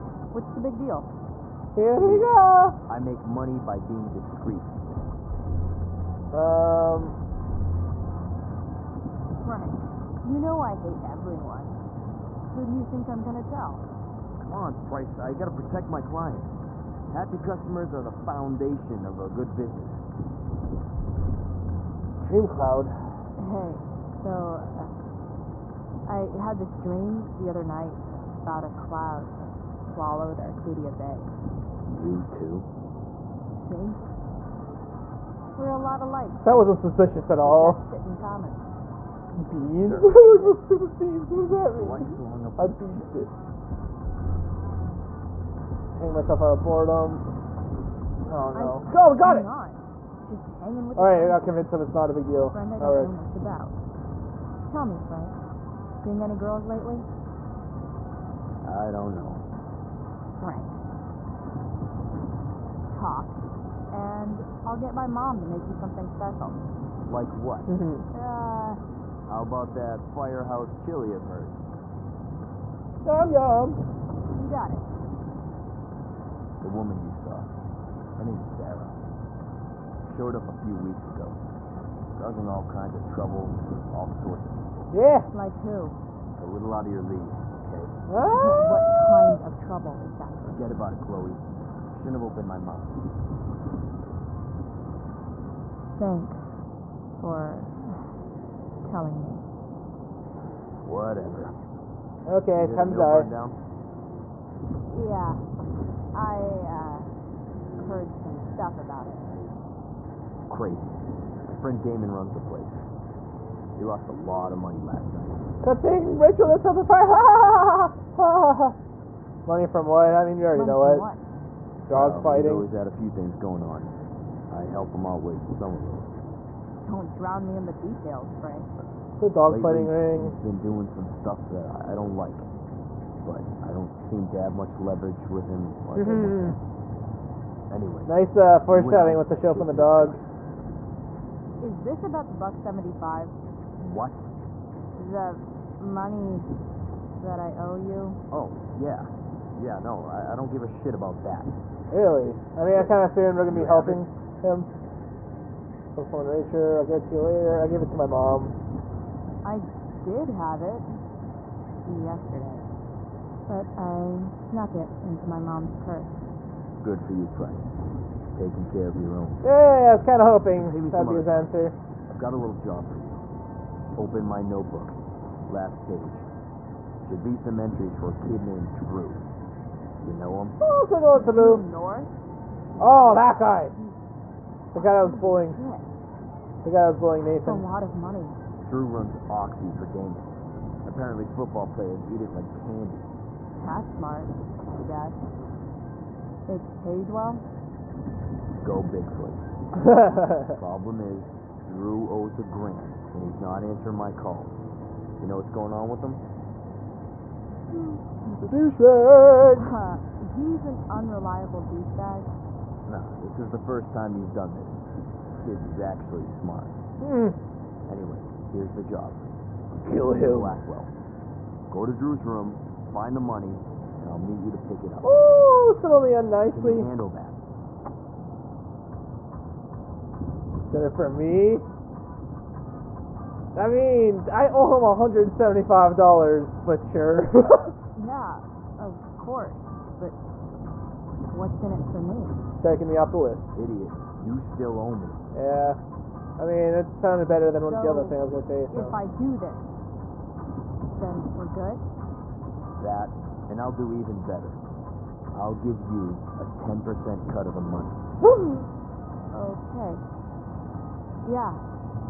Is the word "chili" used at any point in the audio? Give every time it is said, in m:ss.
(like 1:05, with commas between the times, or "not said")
1:10.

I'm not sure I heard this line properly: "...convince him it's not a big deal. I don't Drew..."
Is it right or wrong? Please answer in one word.
wrong.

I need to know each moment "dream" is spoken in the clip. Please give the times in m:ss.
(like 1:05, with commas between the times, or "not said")
0:22, 0:26.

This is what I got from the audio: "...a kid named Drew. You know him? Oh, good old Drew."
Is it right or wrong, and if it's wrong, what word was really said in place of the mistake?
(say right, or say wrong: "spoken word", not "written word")
right.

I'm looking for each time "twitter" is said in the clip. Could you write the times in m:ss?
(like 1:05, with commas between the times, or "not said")
not said.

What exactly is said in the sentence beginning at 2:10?
He's been doing some stuff that I don't like, but I don't seem to have much leverage with him.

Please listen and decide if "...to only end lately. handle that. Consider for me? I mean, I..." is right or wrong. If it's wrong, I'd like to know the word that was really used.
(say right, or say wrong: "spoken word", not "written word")
wrong: "nicely", not "lately".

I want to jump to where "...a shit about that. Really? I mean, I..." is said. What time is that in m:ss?
2:30.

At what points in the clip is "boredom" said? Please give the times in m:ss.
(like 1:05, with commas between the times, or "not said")
0:46.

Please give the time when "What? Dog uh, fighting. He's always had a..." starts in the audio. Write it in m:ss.
2:00.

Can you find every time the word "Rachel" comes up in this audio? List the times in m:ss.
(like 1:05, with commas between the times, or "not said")
1:56, 2:36.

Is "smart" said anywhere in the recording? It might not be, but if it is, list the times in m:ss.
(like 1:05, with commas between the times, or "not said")
3:13, 3:36.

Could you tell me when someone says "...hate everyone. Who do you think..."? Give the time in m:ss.
0:10.